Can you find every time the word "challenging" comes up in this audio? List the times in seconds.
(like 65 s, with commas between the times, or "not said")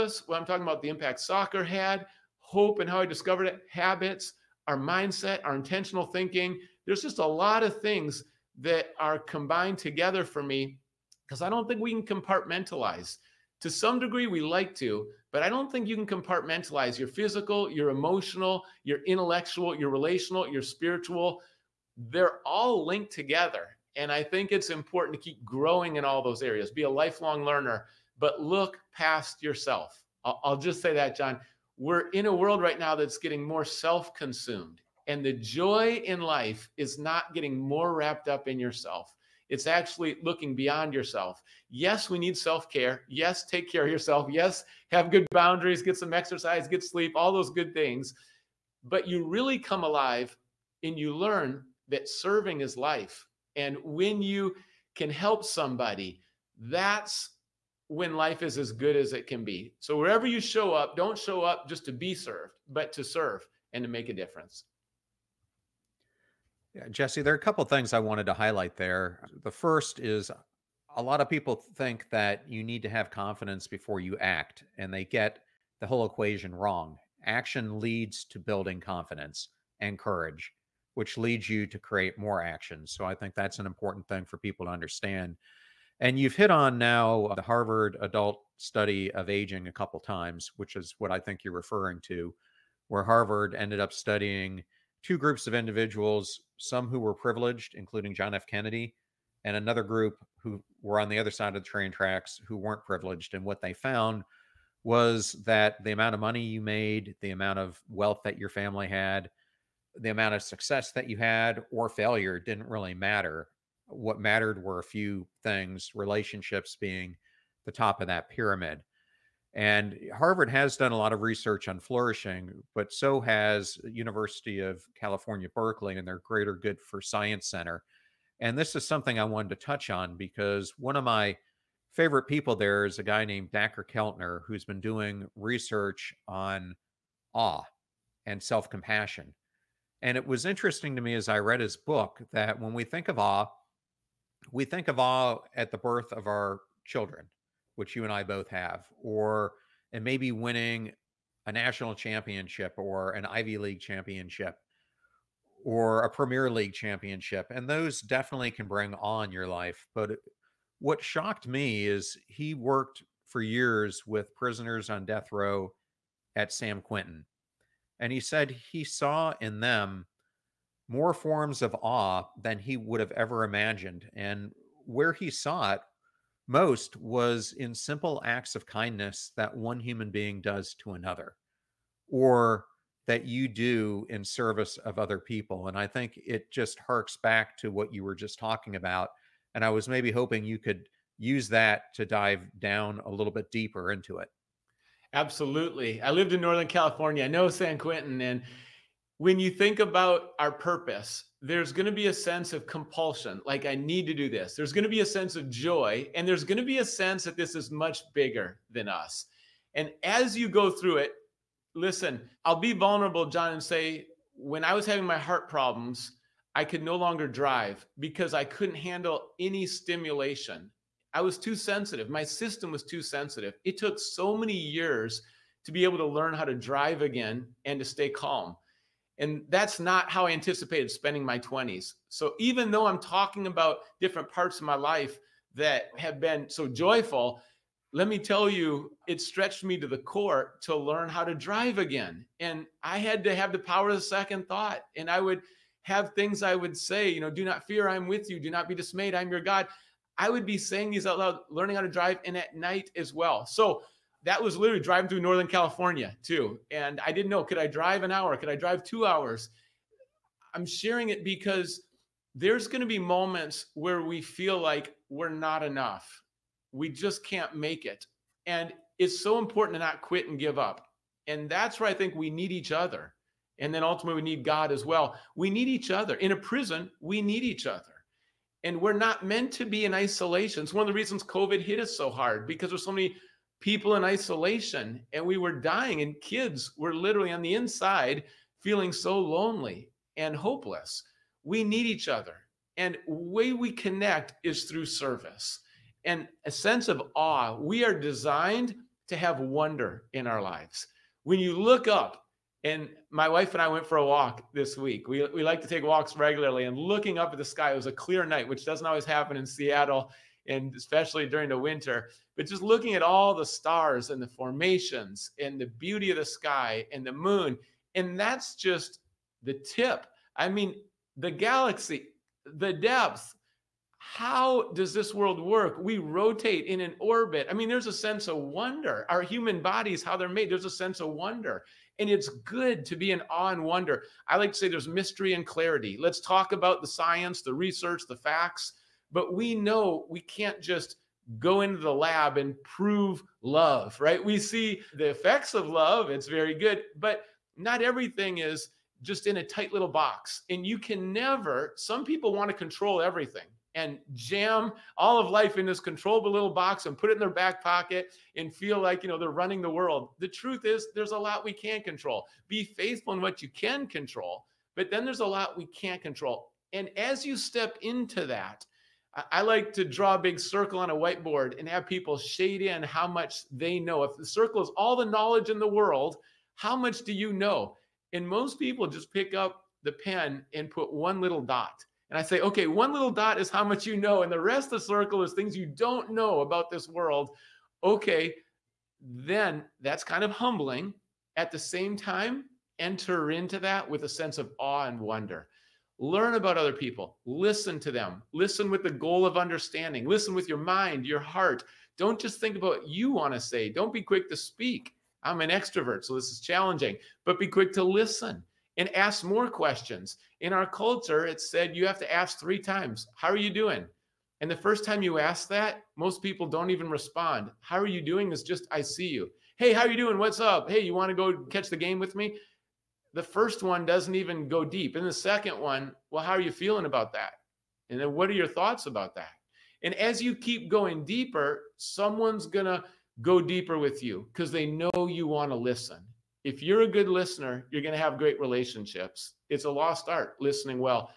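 406 s.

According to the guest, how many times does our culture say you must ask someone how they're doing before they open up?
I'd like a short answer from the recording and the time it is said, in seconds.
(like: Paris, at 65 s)
3, at 412 s.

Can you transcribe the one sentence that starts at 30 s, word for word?
I'll, I'll just say that, John.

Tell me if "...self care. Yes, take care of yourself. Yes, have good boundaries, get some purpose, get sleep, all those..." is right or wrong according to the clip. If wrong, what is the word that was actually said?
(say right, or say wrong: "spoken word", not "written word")
wrong: "exercise", not "purpose".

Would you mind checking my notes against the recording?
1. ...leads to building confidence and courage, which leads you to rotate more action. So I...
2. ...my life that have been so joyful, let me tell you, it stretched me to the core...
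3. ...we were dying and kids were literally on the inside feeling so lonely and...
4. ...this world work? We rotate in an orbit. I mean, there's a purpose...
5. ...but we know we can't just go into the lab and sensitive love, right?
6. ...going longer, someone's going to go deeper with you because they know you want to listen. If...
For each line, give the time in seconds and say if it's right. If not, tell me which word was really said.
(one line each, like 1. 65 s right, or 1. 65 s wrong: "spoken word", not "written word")
1. 77 s wrong: "create", not "rotate"
2. 234 s right
3. 285 s right
4. 324 s wrong: "sense", not "purpose"
5. 339 s wrong: "prove", not "sensitive"
6. 430 s wrong: "deeper", not "longer".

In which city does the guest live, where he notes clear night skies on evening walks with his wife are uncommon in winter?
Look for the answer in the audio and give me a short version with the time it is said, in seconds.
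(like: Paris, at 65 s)
Seattle, at 309 s.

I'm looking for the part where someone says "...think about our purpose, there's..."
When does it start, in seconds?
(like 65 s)
199 s.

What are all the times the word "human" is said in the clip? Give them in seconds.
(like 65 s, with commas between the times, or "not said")
179 s, 329 s.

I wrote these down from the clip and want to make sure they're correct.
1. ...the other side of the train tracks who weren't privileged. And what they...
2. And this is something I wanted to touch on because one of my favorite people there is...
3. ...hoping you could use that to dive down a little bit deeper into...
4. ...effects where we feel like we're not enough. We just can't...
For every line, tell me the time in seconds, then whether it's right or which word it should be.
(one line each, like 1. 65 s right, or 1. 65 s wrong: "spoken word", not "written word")
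1. 101 s right
2. 128 s right
3. 190 s right
4. 262 s wrong: "moments", not "effects".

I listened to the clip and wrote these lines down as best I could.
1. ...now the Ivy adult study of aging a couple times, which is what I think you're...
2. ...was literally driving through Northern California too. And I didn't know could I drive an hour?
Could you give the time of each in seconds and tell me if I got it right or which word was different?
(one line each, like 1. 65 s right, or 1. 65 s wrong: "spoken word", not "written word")
1. 86 s wrong: "Harvard", not "Ivy"
2. 254 s right.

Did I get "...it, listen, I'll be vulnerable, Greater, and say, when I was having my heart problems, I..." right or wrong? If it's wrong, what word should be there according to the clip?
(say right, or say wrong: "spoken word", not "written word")
wrong: "John", not "Greater".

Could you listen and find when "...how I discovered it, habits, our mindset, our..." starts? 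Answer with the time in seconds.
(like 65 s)
2 s.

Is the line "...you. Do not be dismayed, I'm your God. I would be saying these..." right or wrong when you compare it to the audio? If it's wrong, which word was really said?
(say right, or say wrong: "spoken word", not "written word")
right.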